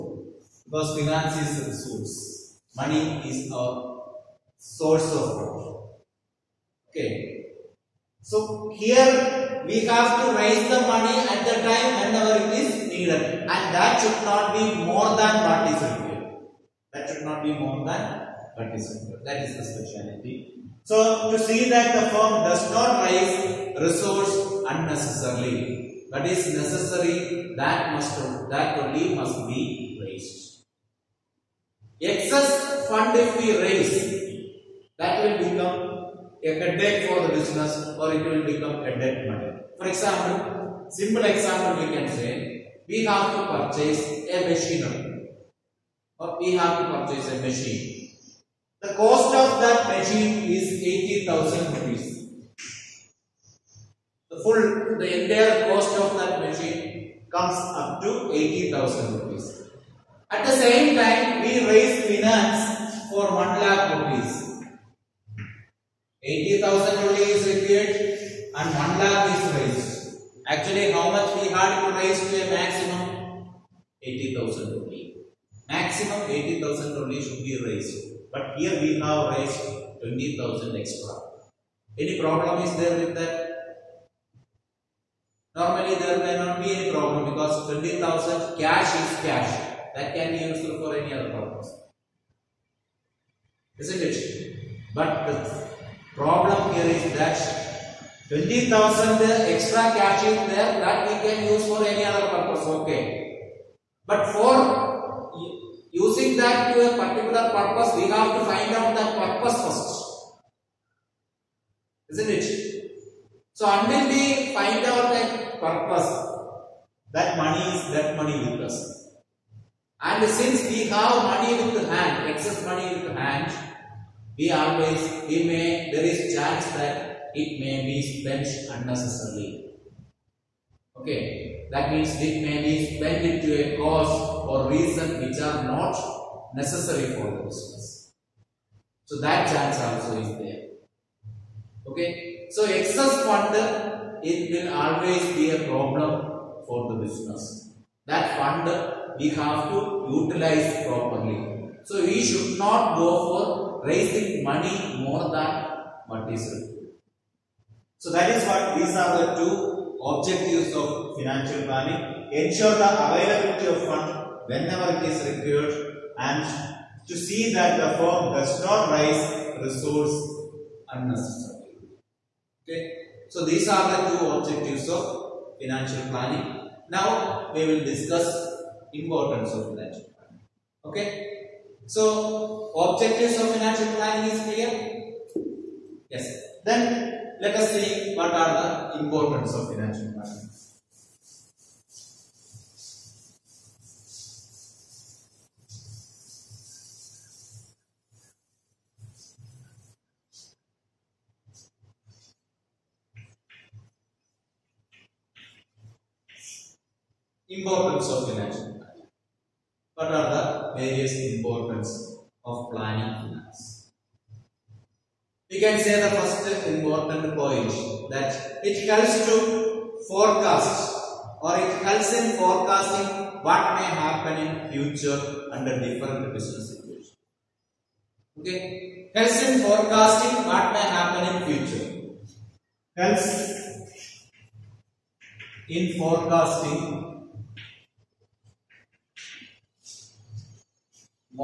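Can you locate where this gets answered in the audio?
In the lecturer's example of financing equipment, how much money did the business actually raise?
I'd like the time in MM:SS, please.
01:03.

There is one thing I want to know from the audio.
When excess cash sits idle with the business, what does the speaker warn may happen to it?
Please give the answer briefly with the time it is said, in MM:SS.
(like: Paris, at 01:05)
spent unnecessarily, at 02:08.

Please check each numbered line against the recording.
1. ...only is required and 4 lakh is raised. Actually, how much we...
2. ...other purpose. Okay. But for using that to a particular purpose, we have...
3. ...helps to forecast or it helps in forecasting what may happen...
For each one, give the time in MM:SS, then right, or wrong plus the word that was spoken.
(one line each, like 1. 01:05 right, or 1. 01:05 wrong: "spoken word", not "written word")
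1. 01:07 wrong: "1", not "4"
2. 01:42 right
3. 03:38 right.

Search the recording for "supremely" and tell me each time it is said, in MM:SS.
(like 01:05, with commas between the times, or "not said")
not said.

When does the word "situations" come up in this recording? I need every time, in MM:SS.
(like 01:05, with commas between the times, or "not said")
03:46.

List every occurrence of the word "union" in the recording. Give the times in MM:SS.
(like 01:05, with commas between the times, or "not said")
not said.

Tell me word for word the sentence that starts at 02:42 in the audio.
Ensure the availability of fund whenever it is required and to see that the firm does not raise resource unnecessarily.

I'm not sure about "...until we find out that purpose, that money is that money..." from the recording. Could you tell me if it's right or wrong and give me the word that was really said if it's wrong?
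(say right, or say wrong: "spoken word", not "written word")
right.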